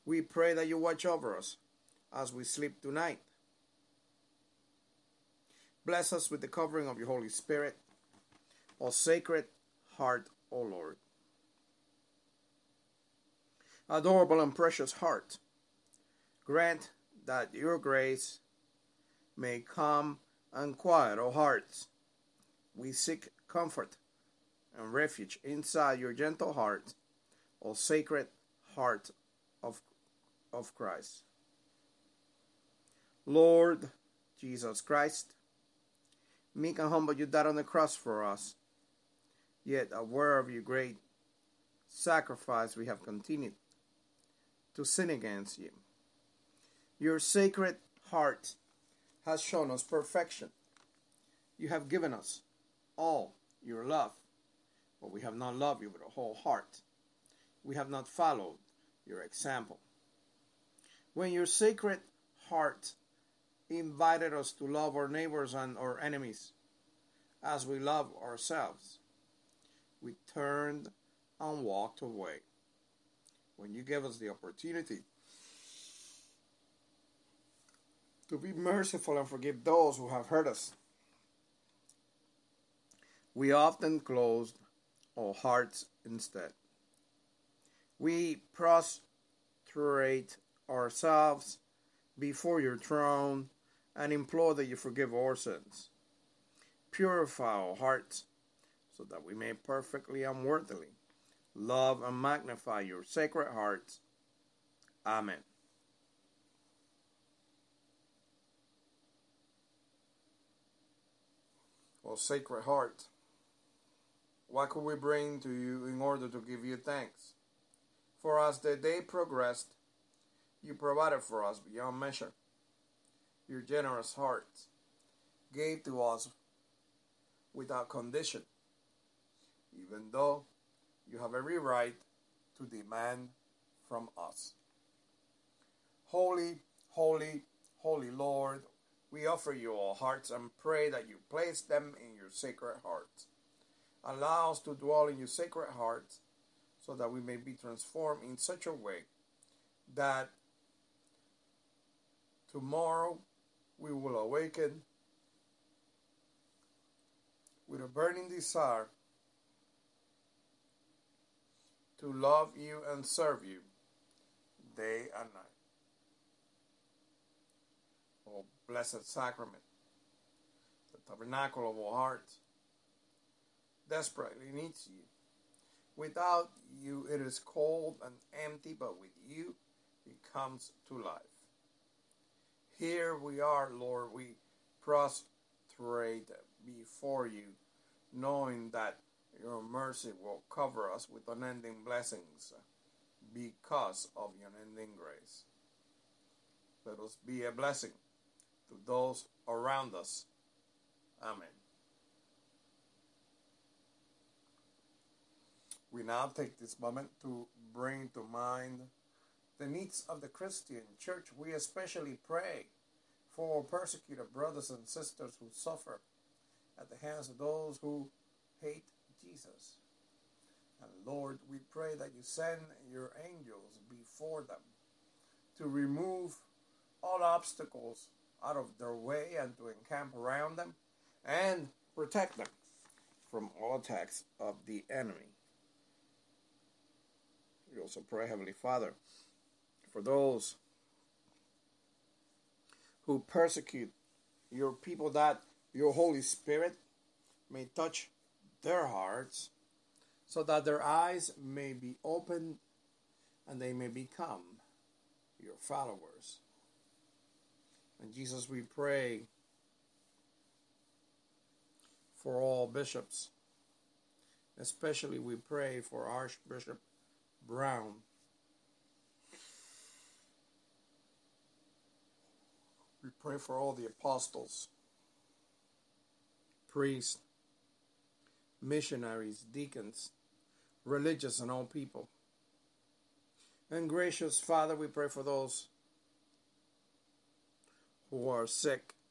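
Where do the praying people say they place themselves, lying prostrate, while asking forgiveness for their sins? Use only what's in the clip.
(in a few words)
before your throne.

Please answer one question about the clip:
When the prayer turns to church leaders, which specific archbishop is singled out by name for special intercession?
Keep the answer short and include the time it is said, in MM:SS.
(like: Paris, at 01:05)
Archbishop Brown, at 04:26.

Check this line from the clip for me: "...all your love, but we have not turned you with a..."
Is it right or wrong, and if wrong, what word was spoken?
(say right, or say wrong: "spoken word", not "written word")
wrong: "loved", not "turned".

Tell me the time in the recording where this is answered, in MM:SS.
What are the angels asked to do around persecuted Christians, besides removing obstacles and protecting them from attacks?
03:49.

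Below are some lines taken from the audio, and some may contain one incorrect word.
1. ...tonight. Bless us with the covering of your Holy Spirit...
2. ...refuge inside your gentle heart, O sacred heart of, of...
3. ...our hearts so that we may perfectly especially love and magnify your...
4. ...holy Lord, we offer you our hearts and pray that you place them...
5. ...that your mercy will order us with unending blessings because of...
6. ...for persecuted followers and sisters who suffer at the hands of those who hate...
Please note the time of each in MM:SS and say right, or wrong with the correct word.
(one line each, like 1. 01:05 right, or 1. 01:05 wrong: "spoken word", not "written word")
1. 00:02 right
2. 00:24 right
3. 01:37 wrong: "unworthily", not "especially"
4. 02:17 right
5. 03:08 wrong: "cover", not "order"
6. 03:33 wrong: "brothers", not "followers".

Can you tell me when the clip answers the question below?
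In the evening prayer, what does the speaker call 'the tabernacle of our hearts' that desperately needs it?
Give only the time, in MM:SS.
02:48.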